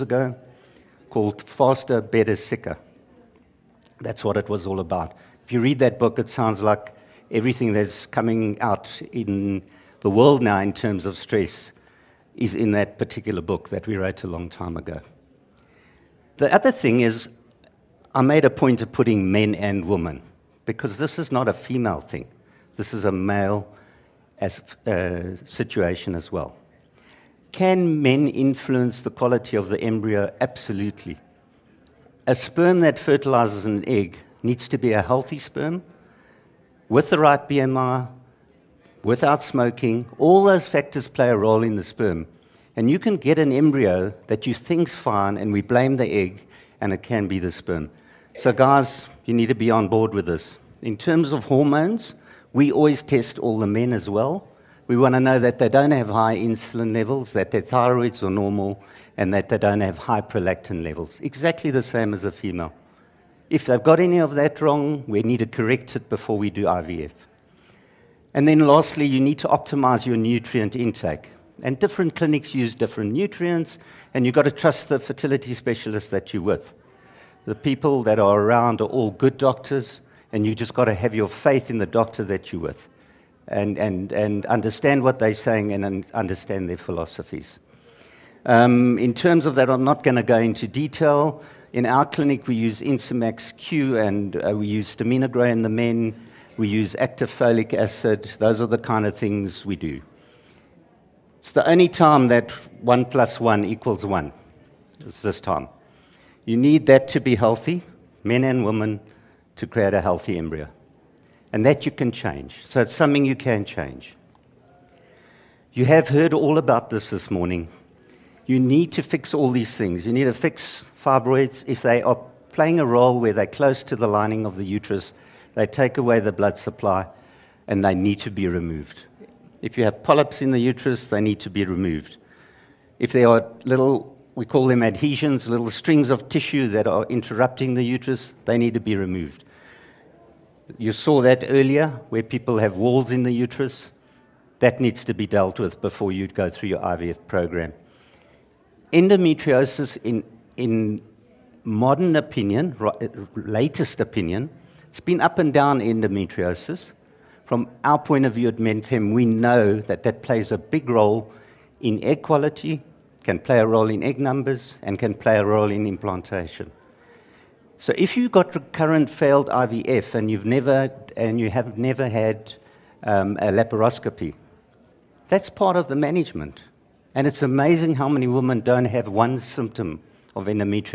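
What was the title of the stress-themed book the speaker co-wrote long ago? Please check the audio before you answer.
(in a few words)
Faster, Better, Sicker.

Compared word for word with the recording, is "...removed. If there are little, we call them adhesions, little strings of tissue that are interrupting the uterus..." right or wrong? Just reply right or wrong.
right.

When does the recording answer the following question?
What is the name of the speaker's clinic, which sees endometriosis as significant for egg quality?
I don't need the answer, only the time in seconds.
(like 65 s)
158 s.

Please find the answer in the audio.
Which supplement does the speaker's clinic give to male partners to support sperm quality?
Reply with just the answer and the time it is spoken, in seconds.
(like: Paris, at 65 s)
Staminogro, at 94 s.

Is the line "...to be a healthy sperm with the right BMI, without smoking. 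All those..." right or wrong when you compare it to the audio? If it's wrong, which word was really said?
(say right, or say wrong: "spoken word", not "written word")
right.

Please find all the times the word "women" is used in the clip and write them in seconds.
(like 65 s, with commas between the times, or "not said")
19 s, 108 s, 178 s.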